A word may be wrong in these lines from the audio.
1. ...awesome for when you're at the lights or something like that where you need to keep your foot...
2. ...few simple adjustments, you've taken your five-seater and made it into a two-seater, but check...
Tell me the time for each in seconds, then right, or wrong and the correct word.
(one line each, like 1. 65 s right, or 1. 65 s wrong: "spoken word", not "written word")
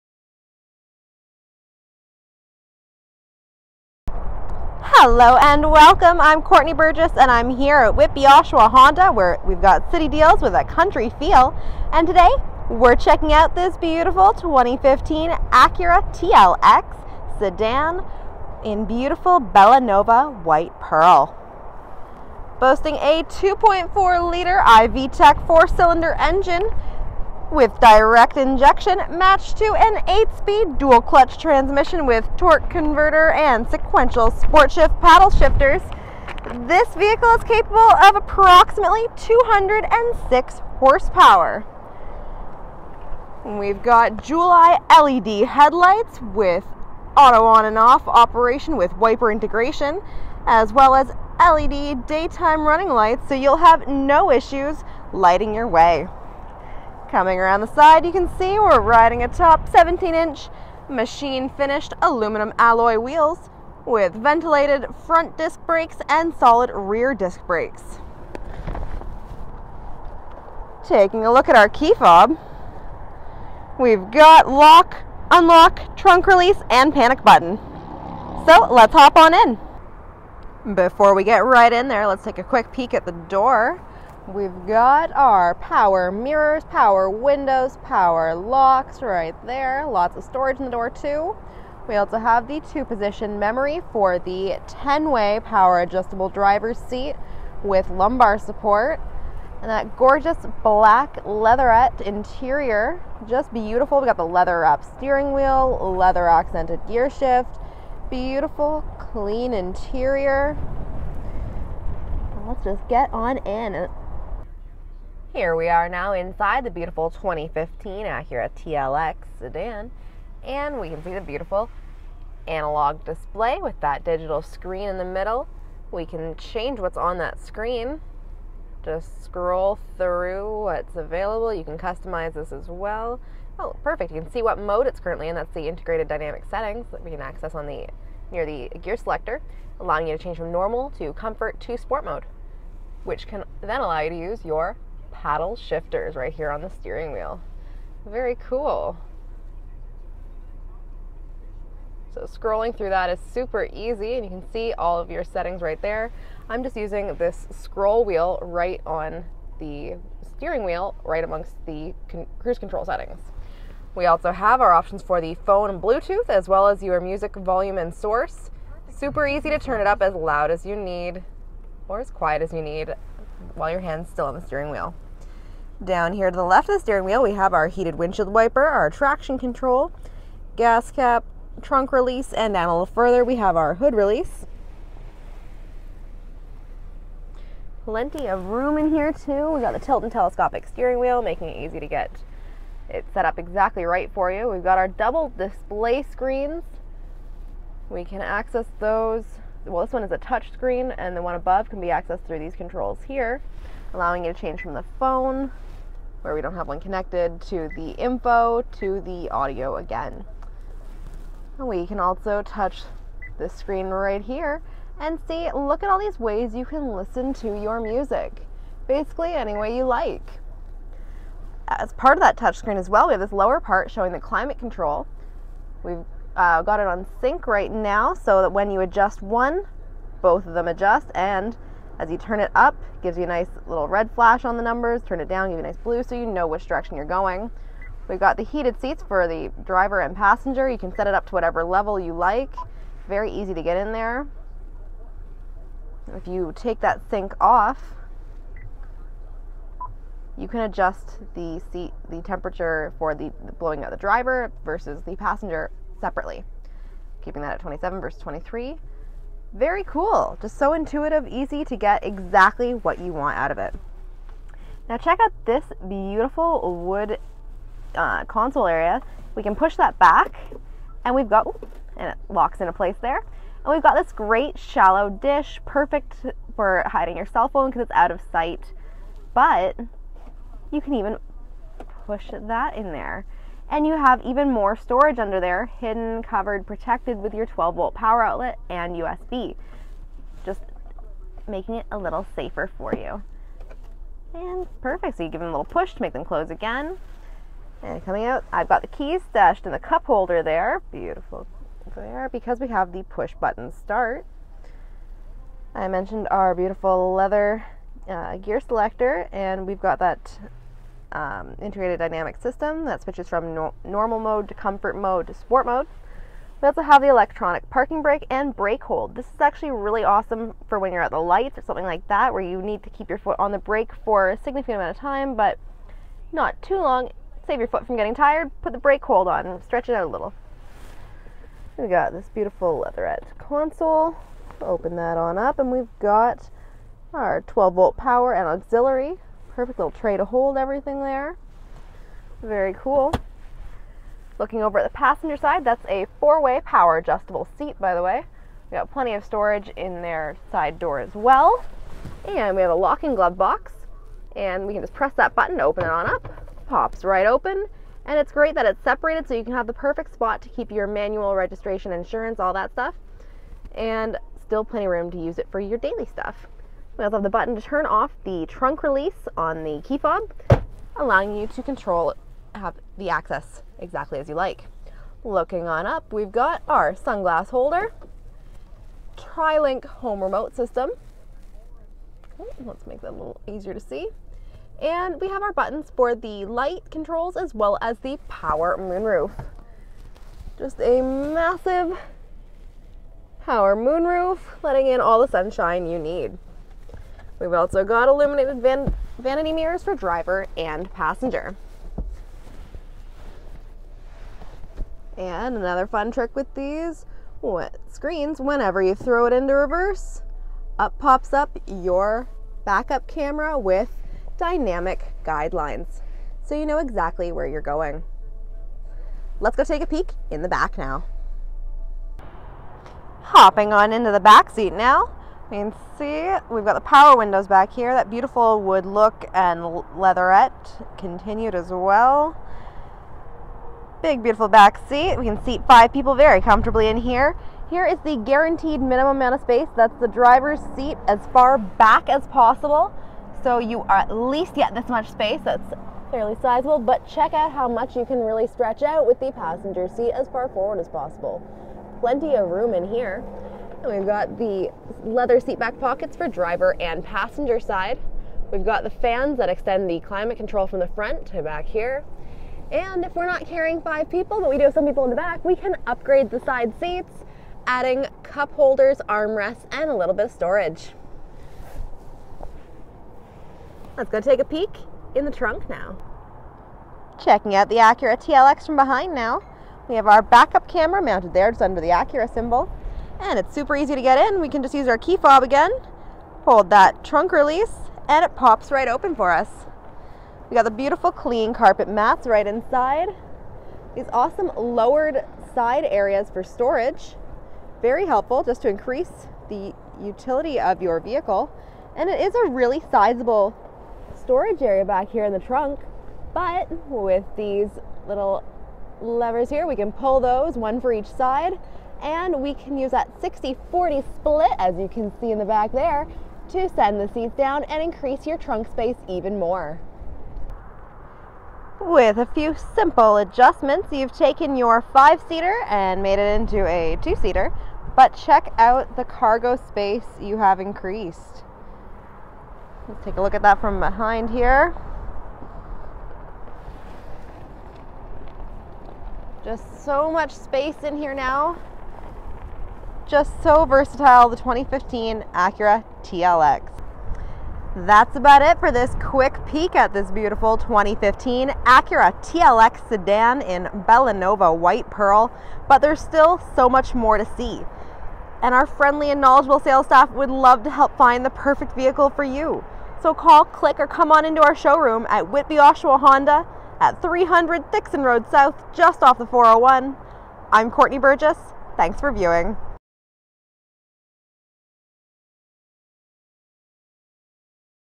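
1. 320 s right
2. 522 s right.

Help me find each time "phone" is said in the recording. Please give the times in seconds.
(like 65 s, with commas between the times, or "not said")
165 s, 204 s, 277 s.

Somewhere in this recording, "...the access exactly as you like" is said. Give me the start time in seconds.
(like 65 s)
372 s.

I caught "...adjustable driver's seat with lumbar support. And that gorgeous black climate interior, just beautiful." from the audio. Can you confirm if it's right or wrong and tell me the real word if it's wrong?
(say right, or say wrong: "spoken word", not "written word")
wrong: "leatherette", not "climate".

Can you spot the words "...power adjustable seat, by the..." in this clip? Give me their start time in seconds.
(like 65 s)
346 s.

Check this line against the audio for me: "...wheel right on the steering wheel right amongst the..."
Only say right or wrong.
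right.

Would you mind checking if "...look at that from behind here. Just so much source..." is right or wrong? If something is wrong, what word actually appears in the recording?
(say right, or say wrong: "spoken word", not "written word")
wrong: "space", not "source".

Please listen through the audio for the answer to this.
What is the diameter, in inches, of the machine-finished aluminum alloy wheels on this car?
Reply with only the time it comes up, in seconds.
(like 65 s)
59 s.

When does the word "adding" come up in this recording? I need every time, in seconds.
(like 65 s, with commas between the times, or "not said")
467 s.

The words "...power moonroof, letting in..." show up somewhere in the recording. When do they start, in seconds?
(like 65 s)
393 s.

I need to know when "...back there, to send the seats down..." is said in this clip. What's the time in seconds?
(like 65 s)
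515 s.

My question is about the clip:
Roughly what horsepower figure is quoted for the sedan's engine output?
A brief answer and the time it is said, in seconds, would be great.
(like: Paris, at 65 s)
206, at 39 s.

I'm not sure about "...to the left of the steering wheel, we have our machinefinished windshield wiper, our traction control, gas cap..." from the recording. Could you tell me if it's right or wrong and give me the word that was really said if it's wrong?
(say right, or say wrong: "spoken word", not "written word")
wrong: "heated", not "machinefinished".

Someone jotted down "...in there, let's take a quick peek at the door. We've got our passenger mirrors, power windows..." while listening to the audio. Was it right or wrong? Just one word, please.
wrong.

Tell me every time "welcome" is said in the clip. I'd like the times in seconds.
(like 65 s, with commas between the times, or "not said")
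5 s.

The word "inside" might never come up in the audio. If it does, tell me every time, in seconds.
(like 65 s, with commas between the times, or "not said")
116 s, 492 s.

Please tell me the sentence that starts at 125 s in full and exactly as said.
We can change what's on that screen.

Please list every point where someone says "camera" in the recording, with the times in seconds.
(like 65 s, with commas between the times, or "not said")
413 s, 480 s.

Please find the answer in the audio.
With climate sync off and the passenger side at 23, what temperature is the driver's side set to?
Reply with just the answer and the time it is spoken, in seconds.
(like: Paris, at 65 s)
27, at 257 s.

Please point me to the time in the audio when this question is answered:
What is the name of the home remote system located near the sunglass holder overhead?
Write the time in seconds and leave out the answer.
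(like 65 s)
379 s.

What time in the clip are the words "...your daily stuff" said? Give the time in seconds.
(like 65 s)
365 s.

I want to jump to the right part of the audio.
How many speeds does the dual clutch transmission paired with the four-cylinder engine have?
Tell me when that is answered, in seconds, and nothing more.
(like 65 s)
30 s.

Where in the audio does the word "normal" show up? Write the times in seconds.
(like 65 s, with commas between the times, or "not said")
140 s, 313 s.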